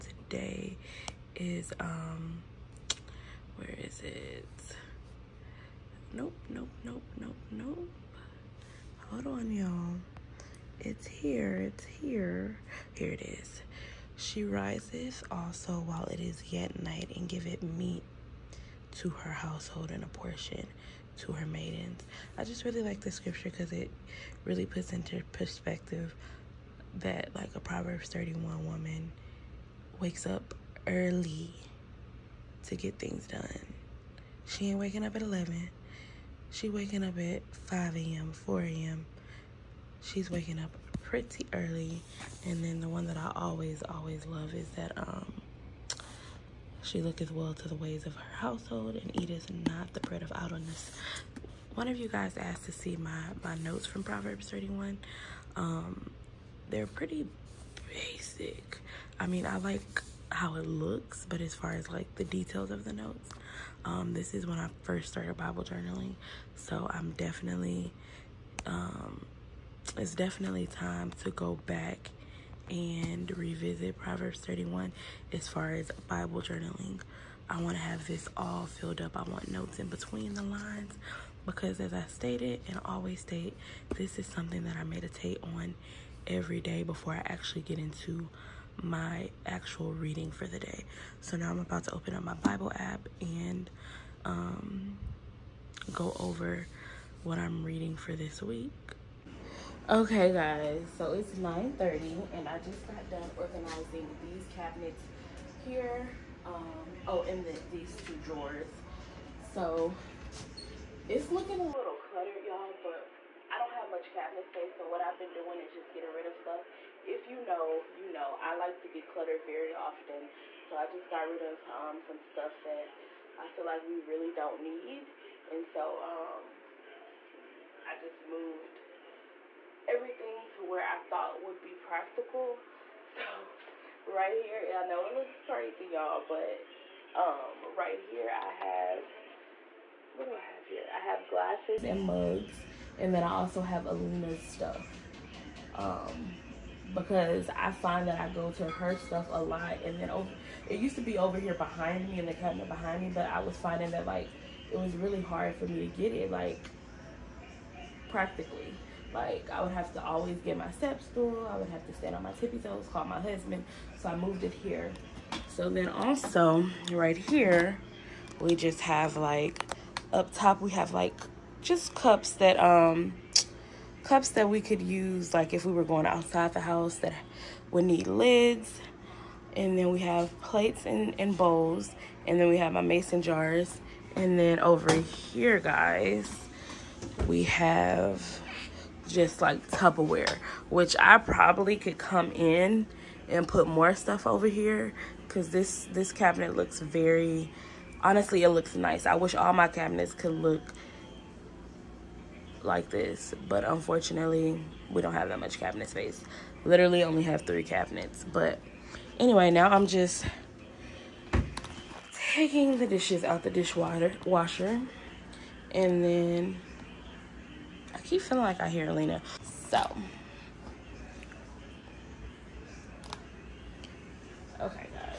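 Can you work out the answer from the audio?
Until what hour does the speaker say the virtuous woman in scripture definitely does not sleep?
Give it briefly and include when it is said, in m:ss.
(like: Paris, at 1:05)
11, at 0:35.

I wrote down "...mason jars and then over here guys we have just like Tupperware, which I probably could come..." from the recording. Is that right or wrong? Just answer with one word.
right.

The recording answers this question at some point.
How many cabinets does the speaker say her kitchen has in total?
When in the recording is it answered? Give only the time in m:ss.
3:27.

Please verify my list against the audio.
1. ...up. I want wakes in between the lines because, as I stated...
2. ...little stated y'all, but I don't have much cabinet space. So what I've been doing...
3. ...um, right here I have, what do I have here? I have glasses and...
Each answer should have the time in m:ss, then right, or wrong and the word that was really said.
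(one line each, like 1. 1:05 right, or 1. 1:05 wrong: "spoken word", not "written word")
1. 1:19 wrong: "notes", not "wakes"
2. 1:51 wrong: "cluttered", not "stated"
3. 2:17 right.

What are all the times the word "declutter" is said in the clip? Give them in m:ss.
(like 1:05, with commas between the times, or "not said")
1:58.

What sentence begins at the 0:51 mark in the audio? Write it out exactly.
One of you guys asked to see my, my notes from Proverbs 31.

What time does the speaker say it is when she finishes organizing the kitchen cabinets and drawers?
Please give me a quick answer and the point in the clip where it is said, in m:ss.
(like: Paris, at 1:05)
9:30, at 1:41.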